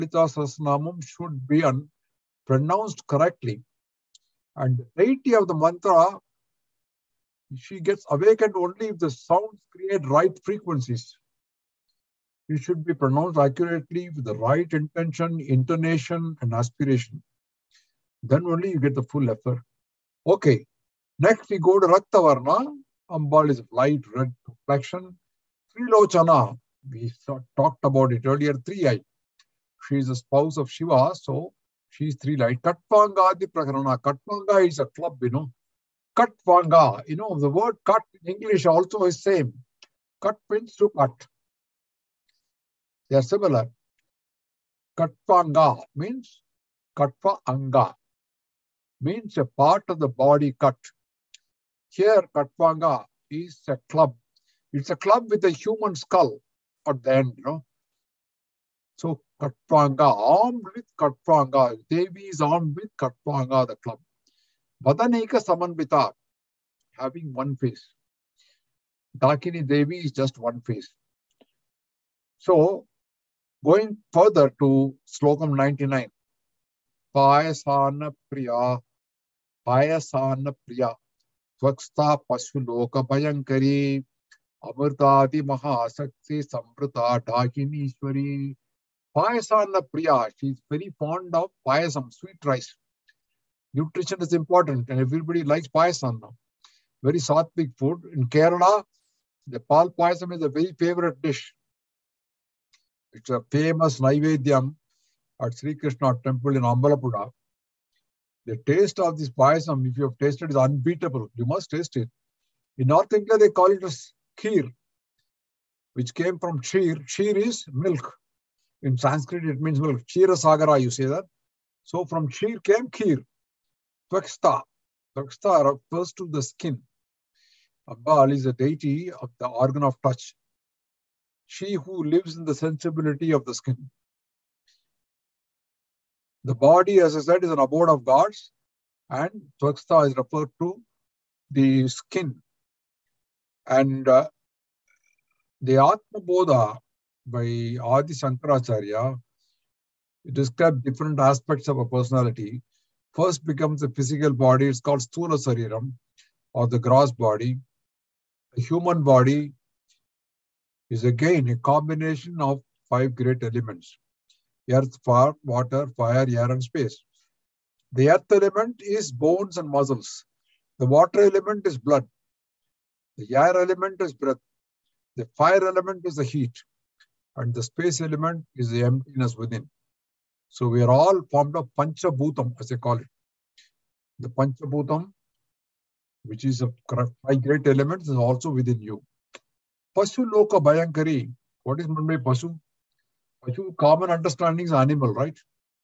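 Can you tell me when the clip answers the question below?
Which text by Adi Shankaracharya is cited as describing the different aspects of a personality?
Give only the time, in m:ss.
2:25.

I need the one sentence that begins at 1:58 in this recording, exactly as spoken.
In Sanskrit, it means well Chira Sagara, you say that.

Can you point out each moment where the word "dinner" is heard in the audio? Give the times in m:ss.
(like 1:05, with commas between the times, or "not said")
not said.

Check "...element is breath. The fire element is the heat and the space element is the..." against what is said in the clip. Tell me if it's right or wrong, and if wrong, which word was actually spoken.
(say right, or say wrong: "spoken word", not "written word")
right.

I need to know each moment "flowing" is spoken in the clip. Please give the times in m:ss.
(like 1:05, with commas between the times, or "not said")
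not said.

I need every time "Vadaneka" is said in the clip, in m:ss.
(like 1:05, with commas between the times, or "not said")
1:04.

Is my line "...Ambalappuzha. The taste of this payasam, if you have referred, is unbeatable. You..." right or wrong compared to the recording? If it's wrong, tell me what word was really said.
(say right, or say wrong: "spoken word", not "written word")
wrong: "tasted", not "referred".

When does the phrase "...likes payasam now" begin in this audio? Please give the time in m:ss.
1:35.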